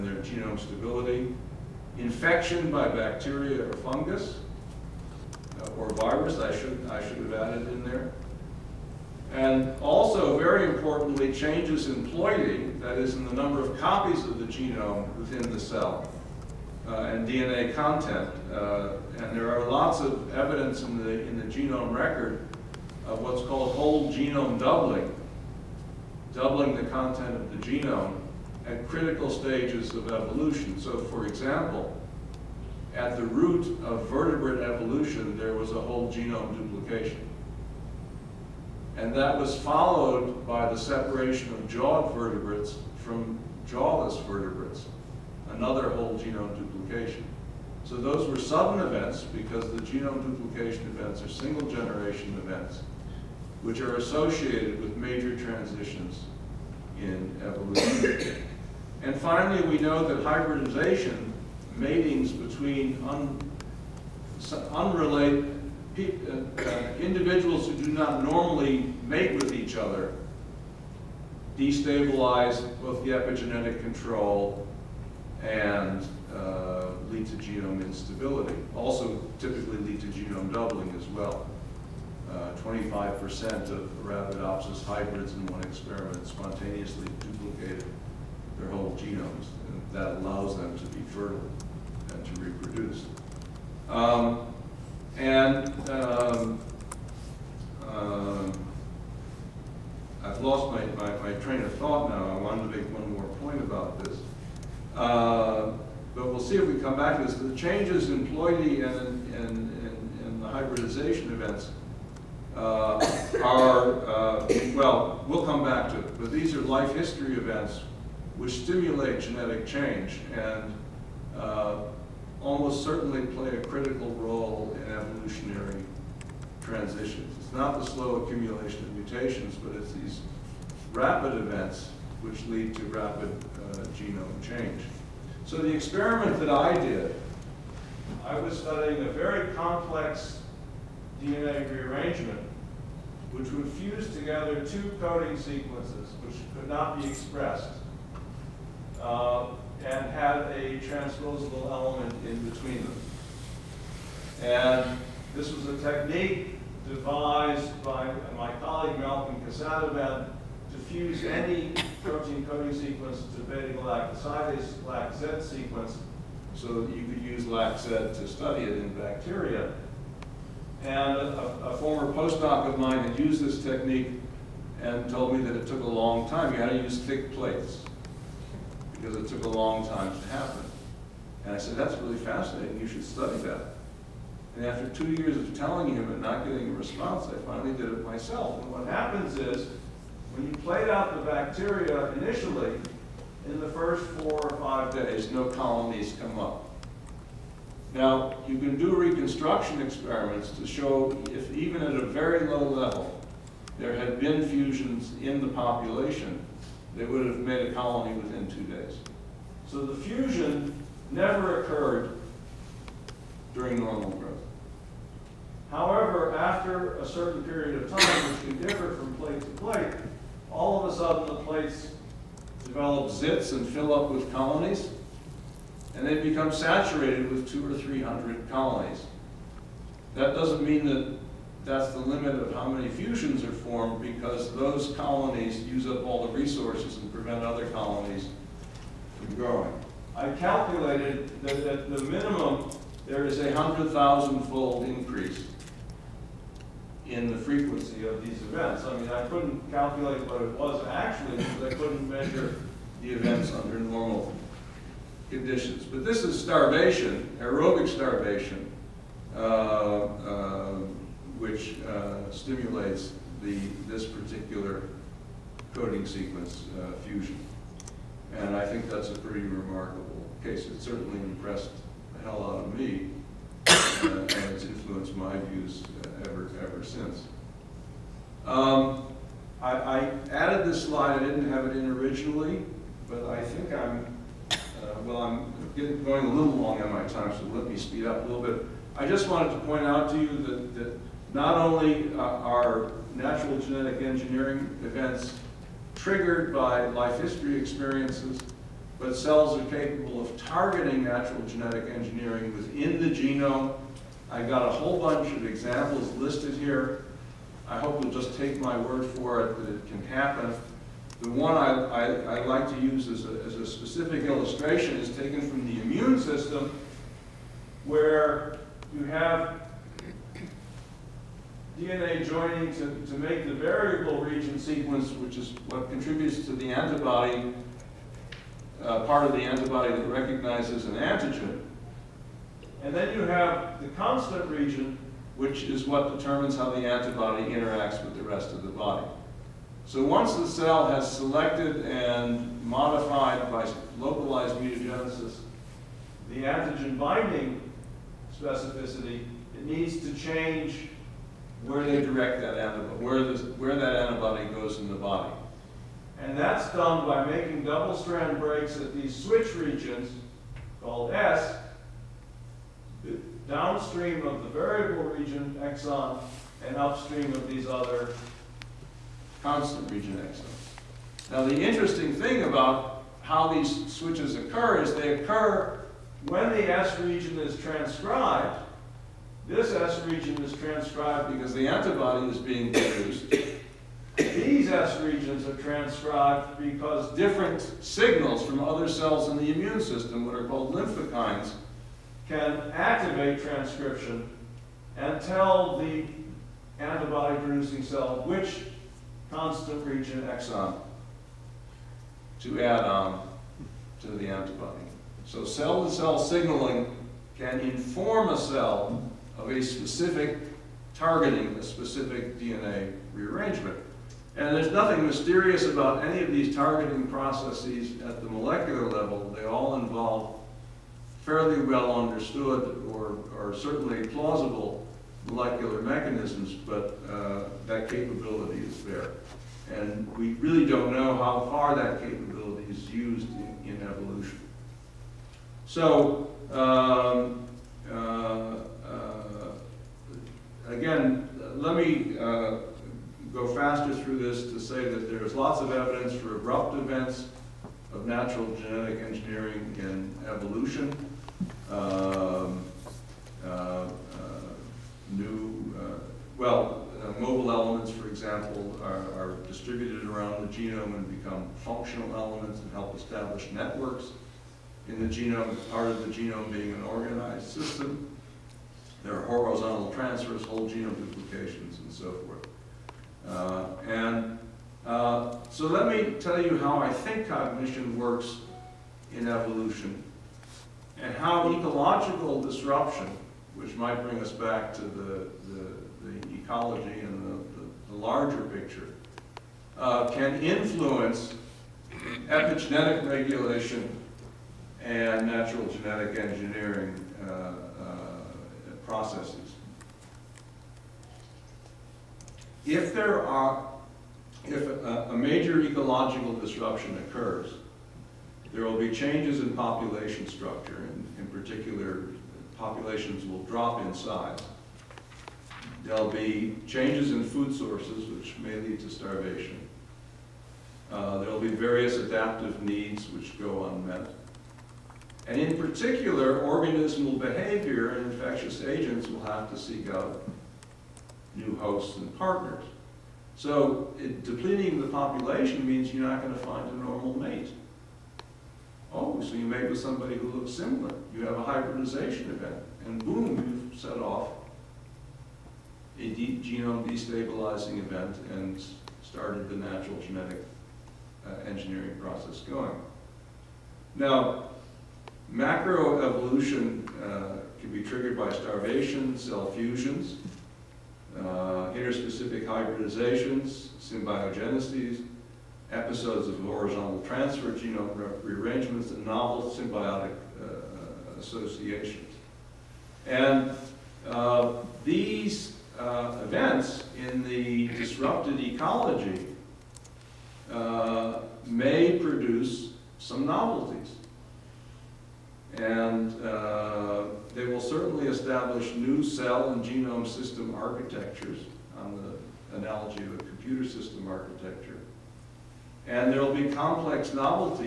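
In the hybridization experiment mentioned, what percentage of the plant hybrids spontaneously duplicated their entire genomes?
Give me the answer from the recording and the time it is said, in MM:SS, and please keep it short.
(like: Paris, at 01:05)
25%, at 01:22.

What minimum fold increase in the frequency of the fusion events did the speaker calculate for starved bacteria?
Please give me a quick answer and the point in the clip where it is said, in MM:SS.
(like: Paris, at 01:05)
100,000-fold, at 04:03.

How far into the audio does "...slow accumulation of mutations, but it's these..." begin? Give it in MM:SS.
02:07.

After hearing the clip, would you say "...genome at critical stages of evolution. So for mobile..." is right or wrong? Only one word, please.
wrong.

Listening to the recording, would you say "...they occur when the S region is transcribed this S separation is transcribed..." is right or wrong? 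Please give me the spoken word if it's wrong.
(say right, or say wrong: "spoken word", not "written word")
wrong: "region", not "separation".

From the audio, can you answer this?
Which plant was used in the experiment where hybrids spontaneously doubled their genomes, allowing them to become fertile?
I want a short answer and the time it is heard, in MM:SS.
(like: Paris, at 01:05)
Arabidopsis, at 01:24.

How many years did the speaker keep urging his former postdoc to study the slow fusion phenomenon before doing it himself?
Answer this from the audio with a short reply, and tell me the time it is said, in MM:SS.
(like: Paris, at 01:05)
2, at 03:04.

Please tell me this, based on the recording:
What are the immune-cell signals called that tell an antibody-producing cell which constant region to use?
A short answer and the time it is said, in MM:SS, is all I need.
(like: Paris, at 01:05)
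Lymphokines, at 06:30.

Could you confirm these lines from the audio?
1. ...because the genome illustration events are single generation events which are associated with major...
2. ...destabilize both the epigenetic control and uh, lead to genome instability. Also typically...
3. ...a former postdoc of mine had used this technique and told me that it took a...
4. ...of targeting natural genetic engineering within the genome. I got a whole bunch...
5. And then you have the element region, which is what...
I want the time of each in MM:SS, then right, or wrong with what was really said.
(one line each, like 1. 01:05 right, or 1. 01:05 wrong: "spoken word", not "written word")
1. 00:49 wrong: "duplication", not "illustration"
2. 01:11 right
3. 02:51 right
4. 05:00 right
5. 05:32 wrong: "constant", not "element".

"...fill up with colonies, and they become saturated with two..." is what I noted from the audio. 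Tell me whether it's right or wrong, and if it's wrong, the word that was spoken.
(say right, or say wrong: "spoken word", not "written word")
right.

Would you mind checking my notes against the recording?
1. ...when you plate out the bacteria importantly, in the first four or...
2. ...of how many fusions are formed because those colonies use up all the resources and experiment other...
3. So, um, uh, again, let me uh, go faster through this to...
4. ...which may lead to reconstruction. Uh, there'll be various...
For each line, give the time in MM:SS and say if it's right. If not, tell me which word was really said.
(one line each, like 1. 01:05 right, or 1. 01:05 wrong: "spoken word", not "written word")
1. 03:10 wrong: "initially", not "importantly"
2. 03:52 wrong: "prevent", not "experiment"
3. 07:15 right
4. 08:38 wrong: "starvation", not "reconstruction".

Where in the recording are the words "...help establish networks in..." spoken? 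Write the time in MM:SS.
07:42.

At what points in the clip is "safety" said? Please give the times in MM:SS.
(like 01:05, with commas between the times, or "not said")
not said.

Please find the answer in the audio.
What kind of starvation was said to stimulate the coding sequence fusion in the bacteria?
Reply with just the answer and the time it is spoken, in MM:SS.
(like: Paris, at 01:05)
Aerobic starvation, at 04:17.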